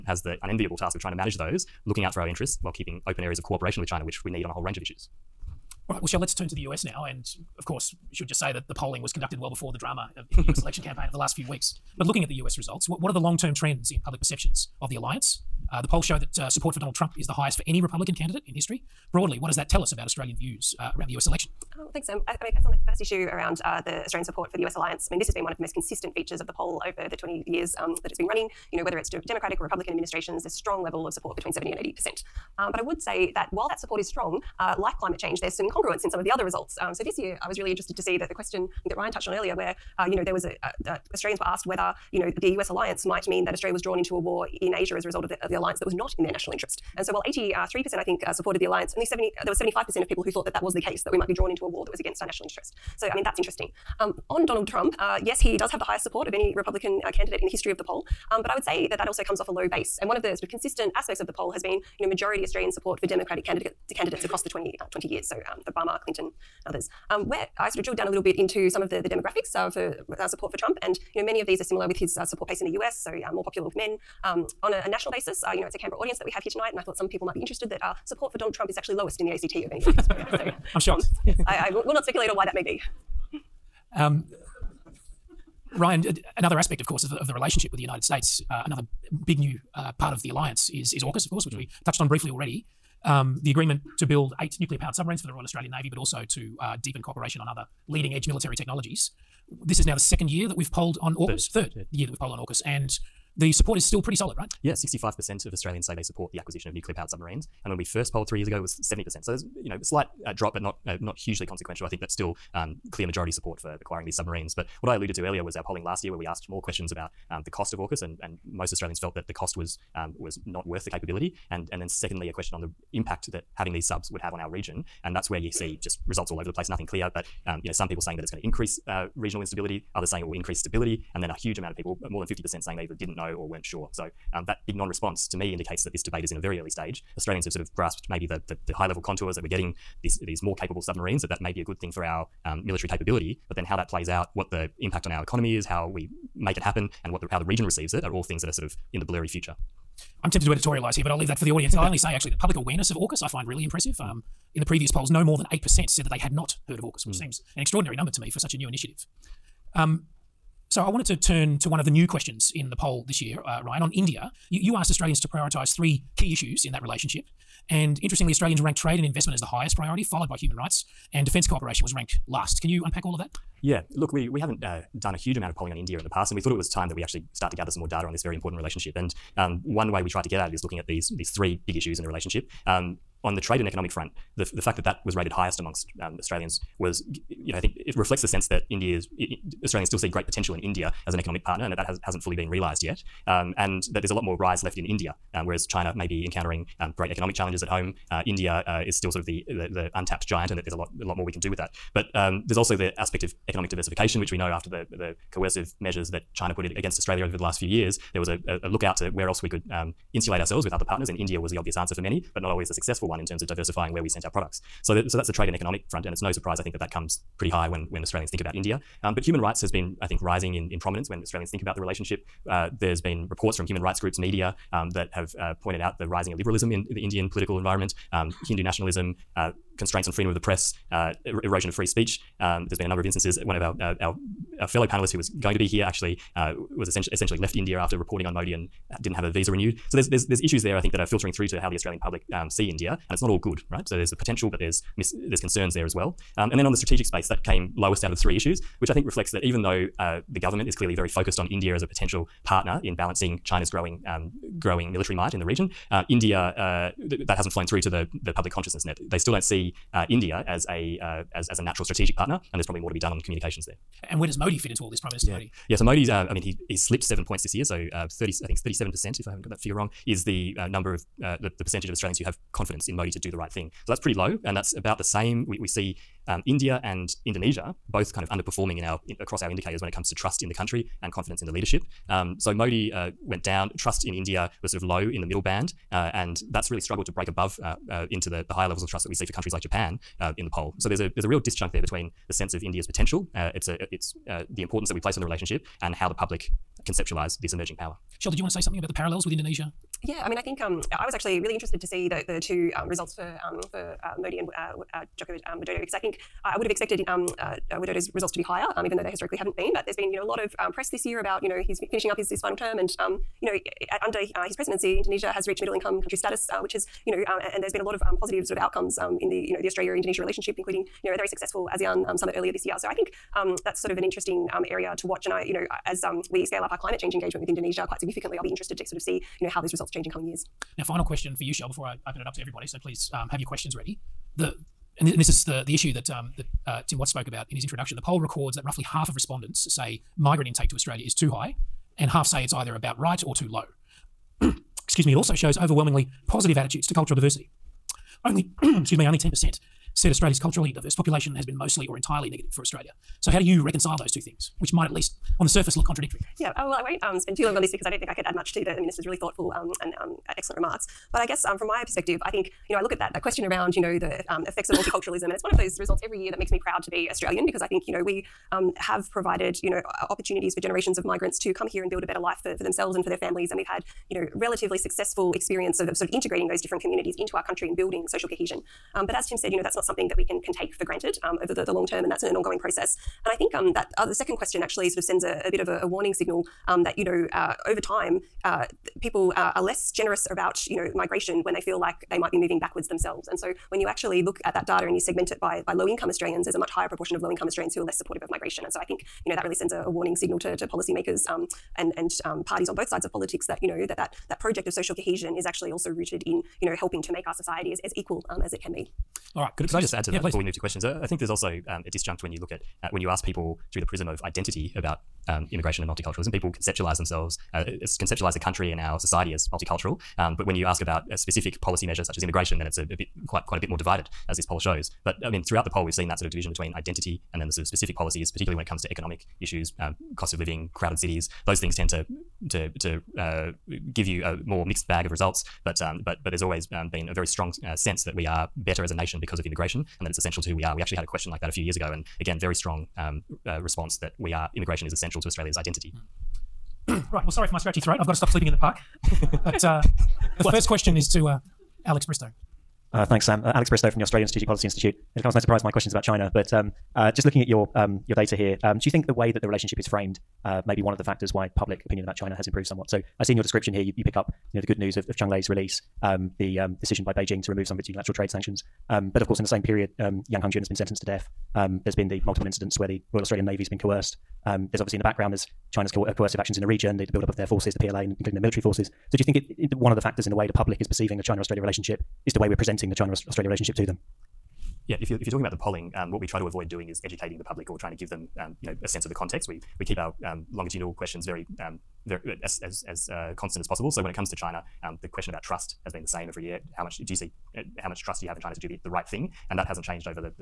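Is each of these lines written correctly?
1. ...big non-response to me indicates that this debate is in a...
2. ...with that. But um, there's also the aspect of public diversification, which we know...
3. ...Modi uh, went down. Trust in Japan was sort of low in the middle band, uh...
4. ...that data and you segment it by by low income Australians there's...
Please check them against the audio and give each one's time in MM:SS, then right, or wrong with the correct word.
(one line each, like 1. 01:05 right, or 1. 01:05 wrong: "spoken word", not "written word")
1. 02:14 right
2. 03:21 wrong: "economic", not "public"
3. 04:42 wrong: "India", not "Japan"
4. 06:34 right.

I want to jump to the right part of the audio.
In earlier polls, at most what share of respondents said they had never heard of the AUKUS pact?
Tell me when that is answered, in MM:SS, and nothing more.
02:35.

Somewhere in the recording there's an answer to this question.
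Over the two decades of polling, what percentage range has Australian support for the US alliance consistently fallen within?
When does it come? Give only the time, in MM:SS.
00:31.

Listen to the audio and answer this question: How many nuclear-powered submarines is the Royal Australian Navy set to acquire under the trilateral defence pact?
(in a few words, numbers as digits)
8.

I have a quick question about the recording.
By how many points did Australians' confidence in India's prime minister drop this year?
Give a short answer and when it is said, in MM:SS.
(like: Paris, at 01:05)
7, at 04:27.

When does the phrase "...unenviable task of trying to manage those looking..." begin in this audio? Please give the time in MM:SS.
00:00.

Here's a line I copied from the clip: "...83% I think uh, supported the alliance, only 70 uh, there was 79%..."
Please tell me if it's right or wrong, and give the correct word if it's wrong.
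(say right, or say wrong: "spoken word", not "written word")
wrong: "75", not "79".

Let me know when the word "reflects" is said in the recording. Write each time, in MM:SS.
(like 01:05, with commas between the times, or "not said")
03:07, 04:09.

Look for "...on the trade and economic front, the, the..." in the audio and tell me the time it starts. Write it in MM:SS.
03:03.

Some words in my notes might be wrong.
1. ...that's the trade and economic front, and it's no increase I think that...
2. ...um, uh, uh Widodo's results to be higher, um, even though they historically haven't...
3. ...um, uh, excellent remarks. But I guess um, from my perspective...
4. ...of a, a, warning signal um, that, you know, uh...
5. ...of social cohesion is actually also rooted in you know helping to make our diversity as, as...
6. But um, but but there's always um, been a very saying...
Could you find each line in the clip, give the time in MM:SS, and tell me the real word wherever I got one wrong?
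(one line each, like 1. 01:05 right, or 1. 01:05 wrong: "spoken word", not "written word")
1. 03:35 wrong: "surprise", not "increase"
2. 05:07 right
3. 05:59 right
4. 06:25 right
5. 06:44 wrong: "society", not "diversity"
6. 07:15 wrong: "strong", not "saying".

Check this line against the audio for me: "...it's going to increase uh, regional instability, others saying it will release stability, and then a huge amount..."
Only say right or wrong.
wrong.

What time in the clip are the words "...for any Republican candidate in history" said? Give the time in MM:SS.
00:17.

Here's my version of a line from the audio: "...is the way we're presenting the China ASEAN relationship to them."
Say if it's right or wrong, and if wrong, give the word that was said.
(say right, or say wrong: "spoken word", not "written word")
wrong: "Australia", not "ASEAN".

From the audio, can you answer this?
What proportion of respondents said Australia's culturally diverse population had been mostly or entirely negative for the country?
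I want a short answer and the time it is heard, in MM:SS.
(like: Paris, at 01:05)
10%, at 05:49.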